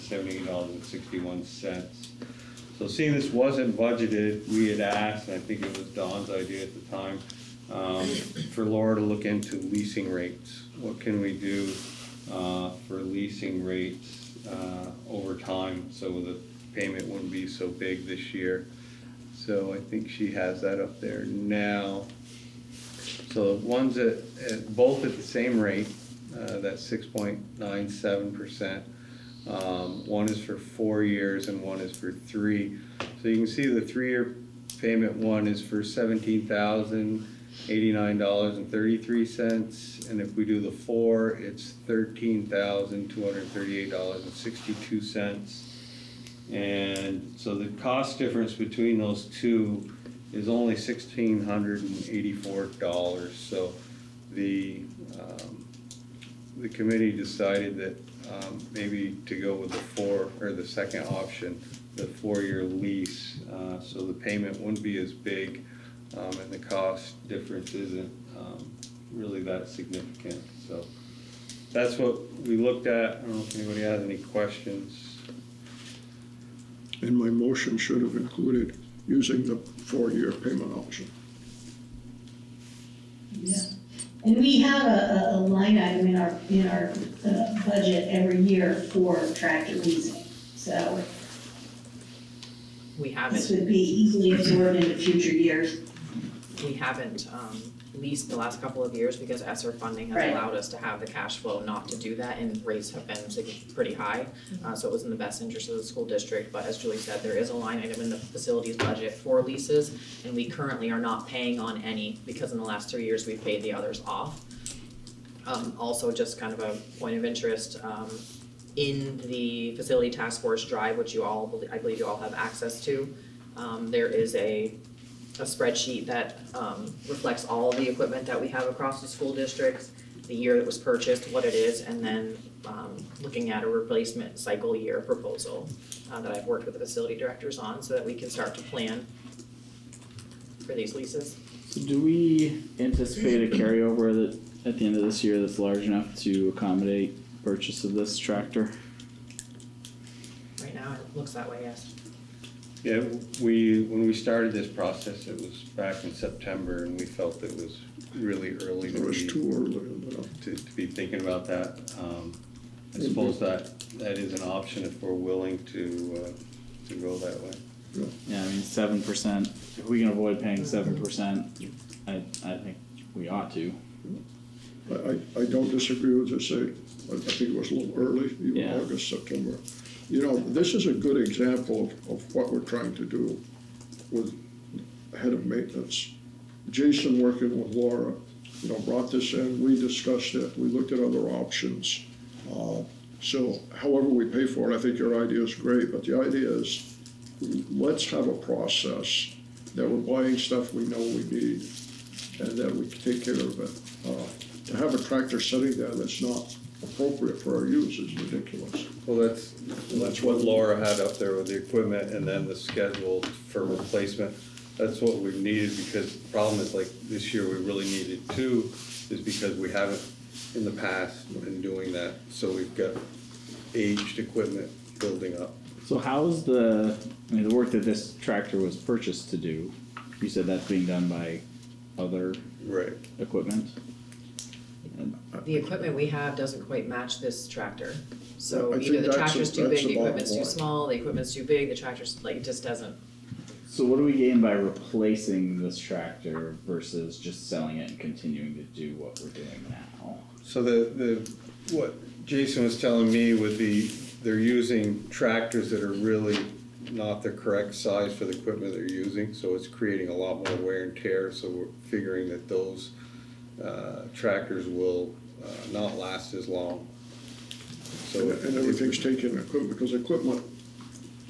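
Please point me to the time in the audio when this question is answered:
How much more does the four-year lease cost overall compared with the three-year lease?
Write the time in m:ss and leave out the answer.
0:50.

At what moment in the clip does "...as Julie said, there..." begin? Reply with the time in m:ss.
1:46.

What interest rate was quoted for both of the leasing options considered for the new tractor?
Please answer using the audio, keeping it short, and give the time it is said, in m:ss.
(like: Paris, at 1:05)
6.97%, at 0:26.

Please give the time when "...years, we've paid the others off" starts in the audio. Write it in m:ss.
1:53.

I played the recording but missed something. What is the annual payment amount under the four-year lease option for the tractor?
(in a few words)
$13,238.62.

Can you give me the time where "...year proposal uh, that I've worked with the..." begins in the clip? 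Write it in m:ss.
2:14.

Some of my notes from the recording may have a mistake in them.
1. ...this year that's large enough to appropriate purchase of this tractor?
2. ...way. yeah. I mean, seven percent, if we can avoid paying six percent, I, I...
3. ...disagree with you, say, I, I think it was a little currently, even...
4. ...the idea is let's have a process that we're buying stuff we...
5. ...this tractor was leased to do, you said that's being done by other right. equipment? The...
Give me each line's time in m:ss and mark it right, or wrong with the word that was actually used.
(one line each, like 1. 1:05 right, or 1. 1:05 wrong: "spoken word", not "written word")
1. 2:25 wrong: "accommodate", not "appropriate"
2. 2:47 wrong: "seven", not "six"
3. 2:55 wrong: "early", not "currently"
4. 3:16 right
5. 3:47 wrong: "purchased", not "leased".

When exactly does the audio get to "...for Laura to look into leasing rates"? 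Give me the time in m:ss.
0:08.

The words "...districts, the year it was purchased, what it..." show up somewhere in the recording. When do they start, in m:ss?
2:09.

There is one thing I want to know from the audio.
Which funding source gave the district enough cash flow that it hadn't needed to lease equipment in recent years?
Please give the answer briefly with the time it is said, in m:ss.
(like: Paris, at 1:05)
ESSER, at 1:39.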